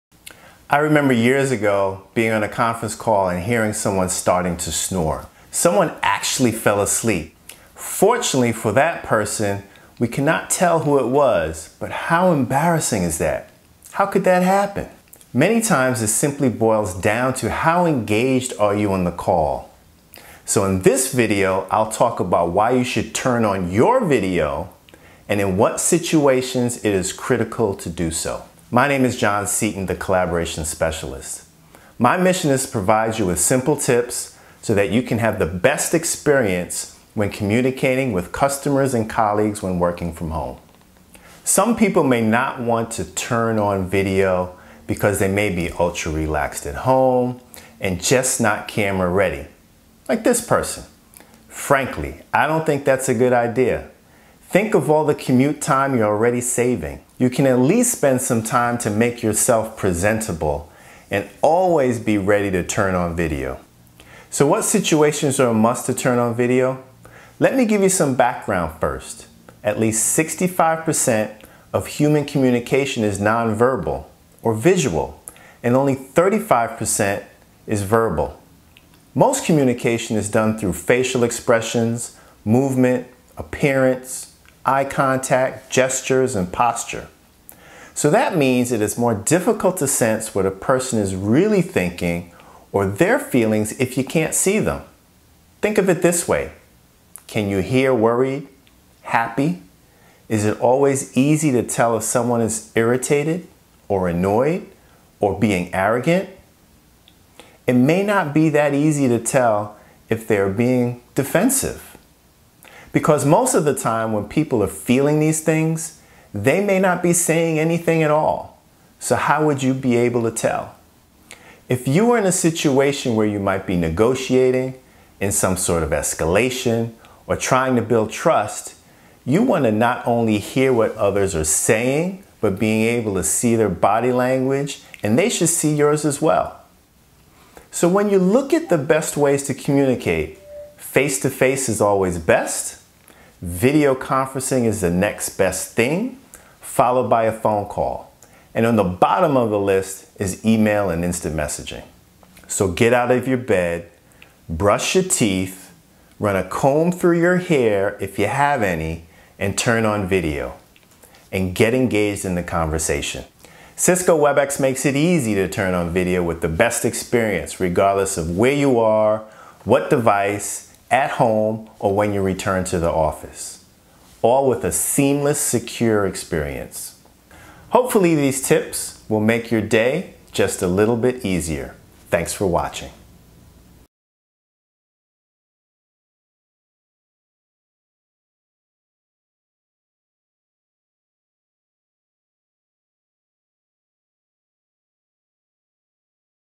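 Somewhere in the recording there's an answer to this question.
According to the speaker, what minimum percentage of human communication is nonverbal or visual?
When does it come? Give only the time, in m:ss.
1:10.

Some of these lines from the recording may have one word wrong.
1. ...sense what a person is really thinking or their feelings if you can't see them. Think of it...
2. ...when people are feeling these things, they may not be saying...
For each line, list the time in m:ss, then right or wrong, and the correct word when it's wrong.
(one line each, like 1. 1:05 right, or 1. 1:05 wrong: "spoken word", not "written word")
1. 1:29 right
2. 1:54 right.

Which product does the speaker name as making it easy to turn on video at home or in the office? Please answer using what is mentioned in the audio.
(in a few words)
Cisco WebEx.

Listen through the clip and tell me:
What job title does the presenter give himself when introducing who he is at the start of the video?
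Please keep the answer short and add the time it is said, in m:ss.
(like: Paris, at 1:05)
Collaboration Specialist, at 0:29.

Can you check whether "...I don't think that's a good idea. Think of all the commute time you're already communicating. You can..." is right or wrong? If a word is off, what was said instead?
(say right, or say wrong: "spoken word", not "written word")
wrong: "saving", not "communicating".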